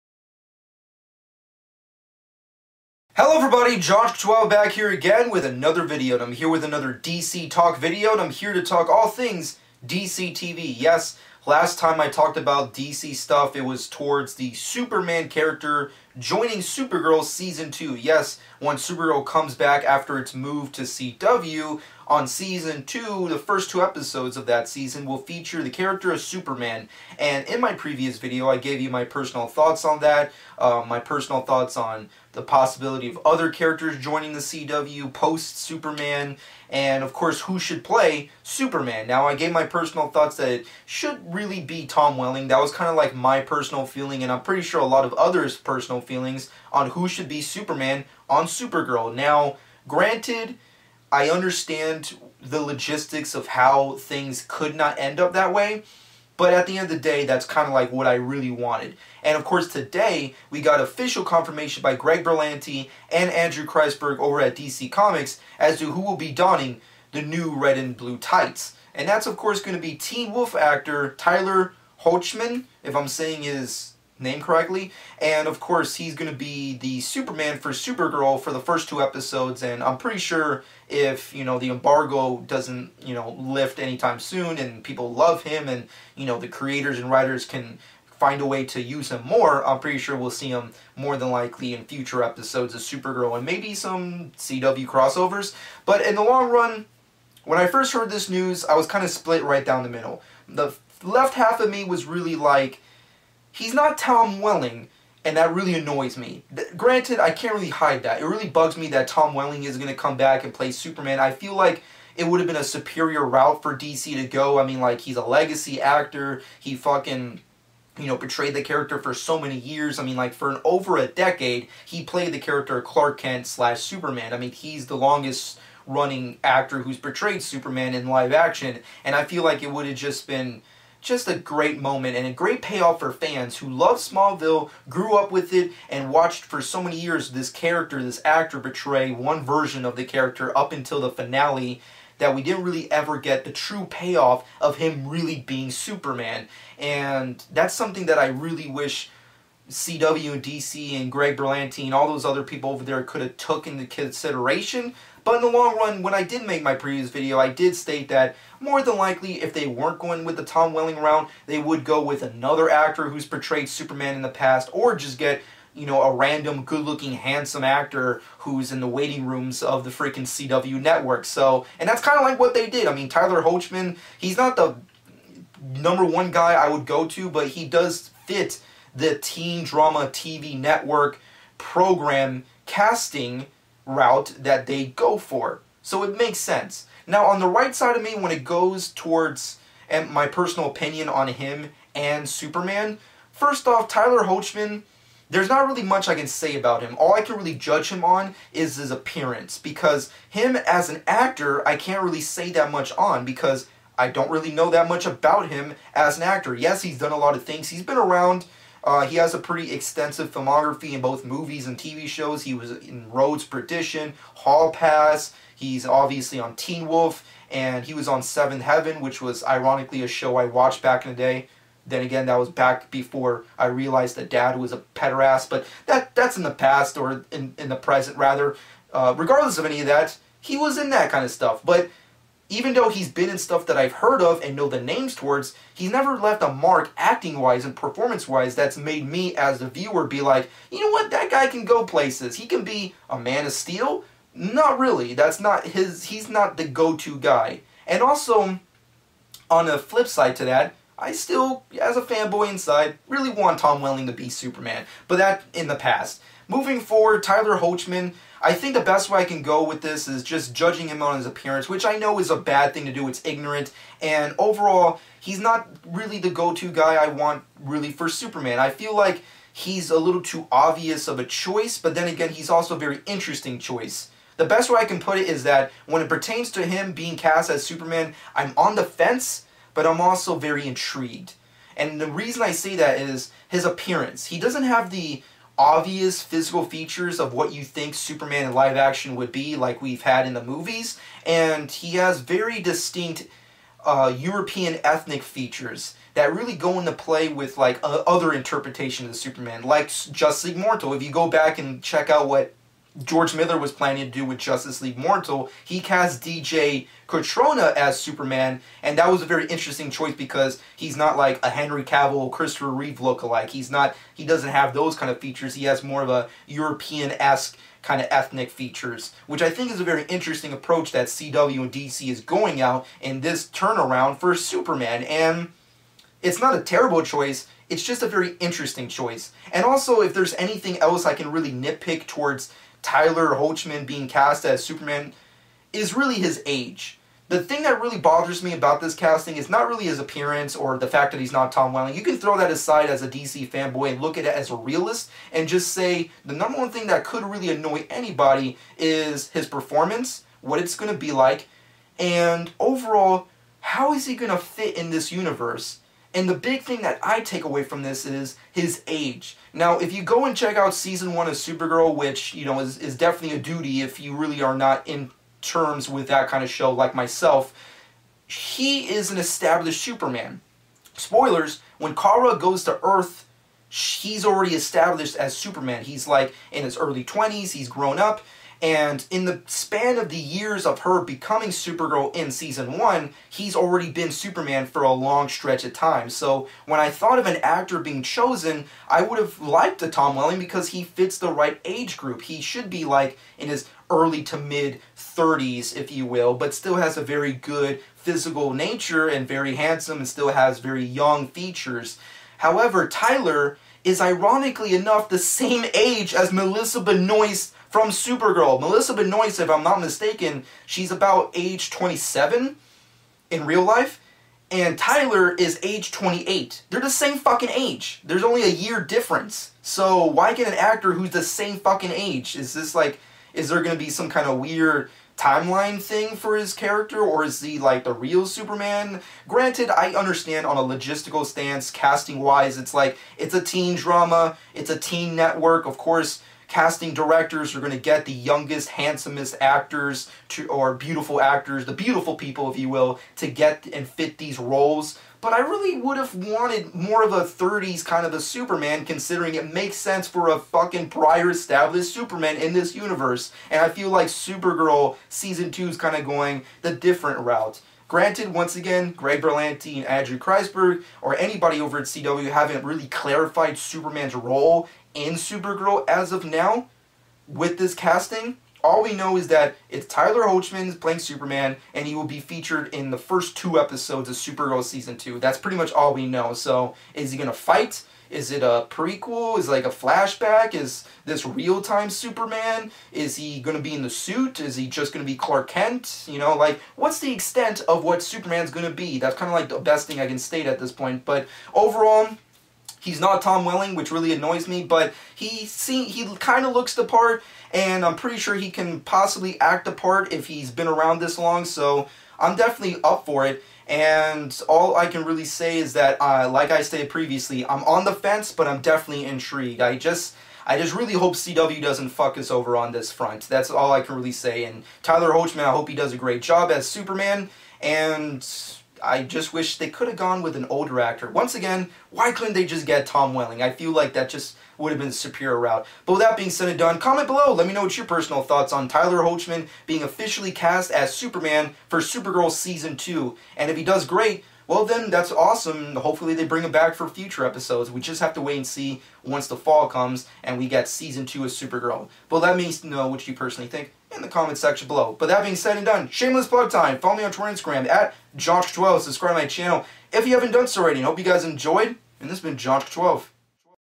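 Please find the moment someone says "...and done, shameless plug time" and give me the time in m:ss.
9:05.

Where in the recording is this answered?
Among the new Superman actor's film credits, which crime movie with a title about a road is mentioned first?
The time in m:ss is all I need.
3:33.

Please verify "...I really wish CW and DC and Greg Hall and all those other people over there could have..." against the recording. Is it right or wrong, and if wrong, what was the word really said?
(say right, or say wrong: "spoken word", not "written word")
wrong: "Berlanti", not "Hall".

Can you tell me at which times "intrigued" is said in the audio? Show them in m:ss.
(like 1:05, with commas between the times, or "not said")
4:40, 8:29.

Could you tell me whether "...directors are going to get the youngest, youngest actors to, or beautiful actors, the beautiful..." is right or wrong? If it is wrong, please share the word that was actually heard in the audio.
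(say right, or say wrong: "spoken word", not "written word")
wrong: "handsomest", not "youngest".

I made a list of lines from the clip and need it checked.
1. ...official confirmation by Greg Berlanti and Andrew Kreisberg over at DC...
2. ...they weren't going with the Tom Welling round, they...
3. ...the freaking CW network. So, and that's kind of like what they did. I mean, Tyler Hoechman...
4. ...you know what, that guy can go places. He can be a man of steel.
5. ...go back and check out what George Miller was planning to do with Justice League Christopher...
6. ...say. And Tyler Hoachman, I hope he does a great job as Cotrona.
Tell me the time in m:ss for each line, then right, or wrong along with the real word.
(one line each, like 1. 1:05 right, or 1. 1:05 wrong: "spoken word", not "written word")
1. 1:00 right
2. 2:39 right
3. 2:49 right
4. 4:00 right
5. 5:01 wrong: "Mortal", not "Christopher"
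6. 8:34 wrong: "Superman", not "Cotrona".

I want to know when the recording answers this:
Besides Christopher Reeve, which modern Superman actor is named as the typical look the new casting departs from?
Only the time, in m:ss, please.
5:11.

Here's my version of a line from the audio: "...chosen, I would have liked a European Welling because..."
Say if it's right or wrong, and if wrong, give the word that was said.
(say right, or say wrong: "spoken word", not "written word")
wrong: "Tom", not "European".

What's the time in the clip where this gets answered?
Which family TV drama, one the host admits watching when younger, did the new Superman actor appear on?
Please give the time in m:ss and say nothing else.
3:38.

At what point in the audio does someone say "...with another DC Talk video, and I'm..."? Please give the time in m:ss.
0:06.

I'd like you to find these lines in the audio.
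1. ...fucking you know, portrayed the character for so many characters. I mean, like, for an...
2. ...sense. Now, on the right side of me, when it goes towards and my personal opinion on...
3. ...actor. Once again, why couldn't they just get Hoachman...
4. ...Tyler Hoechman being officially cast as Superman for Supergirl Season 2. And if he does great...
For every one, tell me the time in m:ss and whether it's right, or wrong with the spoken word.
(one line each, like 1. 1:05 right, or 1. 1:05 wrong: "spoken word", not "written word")
1. 1:56 wrong: "years", not "characters"
2. 3:06 right
3. 8:40 wrong: "Tom", not "Hoachman"
4. 8:48 right.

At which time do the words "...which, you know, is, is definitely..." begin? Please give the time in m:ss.
6:01.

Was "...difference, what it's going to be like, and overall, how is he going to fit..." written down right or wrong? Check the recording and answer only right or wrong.
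wrong.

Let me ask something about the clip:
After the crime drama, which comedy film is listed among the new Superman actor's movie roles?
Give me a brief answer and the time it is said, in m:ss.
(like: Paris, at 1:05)
Hall Pass, at 3:34.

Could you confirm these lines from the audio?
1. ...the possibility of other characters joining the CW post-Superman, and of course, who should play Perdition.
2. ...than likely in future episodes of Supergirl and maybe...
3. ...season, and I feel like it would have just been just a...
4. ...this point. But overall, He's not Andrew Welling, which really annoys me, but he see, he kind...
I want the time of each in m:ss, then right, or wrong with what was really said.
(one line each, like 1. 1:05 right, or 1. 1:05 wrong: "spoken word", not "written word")
1. 0:32 wrong: "Superman", not "Perdition"
2. 1:31 right
3. 2:08 wrong: "action", not "season"
4. 8:10 wrong: "Tom", not "Andrew".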